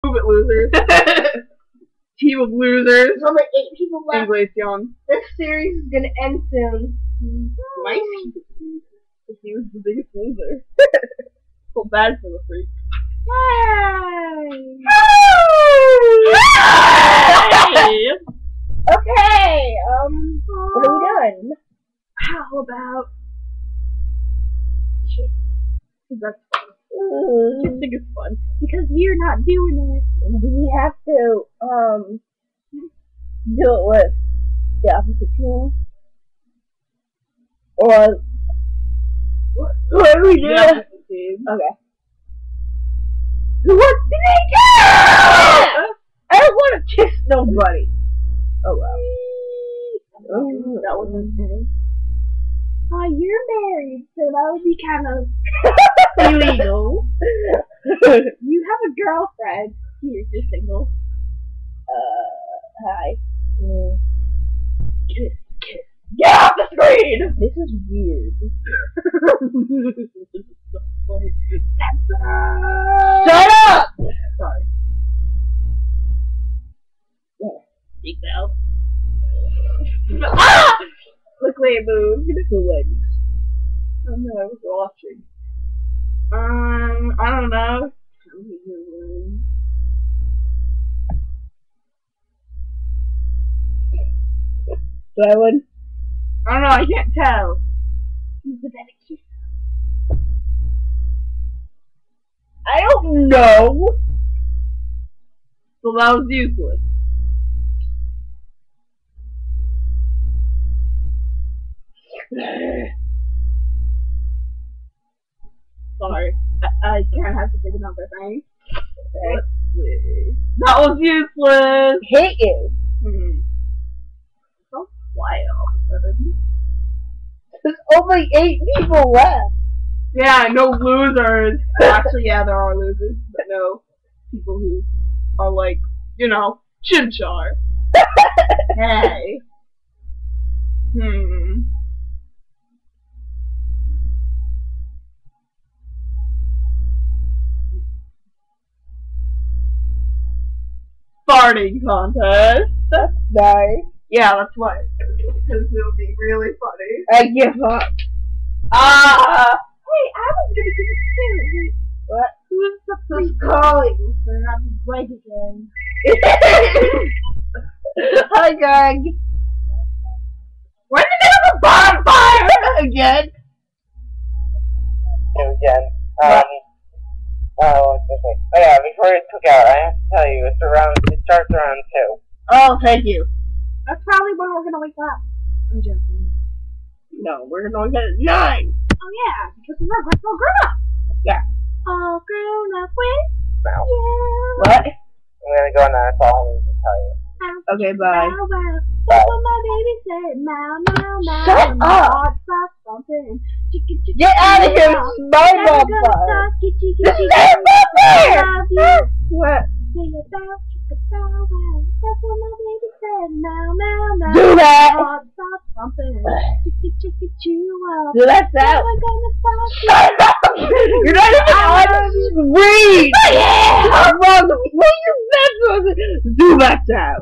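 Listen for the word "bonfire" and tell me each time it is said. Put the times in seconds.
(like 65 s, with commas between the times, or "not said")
171 s, 205 s.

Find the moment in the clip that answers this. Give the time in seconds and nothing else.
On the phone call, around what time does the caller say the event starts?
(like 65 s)
181 s.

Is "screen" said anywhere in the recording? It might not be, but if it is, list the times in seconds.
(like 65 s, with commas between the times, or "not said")
66 s, 222 s.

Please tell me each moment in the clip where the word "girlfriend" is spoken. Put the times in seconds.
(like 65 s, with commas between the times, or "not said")
59 s.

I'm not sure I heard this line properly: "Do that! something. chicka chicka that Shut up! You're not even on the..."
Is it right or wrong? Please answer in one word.
right.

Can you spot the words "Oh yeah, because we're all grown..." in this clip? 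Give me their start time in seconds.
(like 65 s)
188 s.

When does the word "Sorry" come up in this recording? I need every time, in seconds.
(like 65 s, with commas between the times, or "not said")
74 s, 115 s.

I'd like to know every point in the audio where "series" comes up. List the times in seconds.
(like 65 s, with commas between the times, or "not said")
5 s.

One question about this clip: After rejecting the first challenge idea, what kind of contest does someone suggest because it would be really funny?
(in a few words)
Farting contest.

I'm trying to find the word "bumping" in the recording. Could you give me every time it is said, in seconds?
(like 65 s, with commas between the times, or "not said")
202 s.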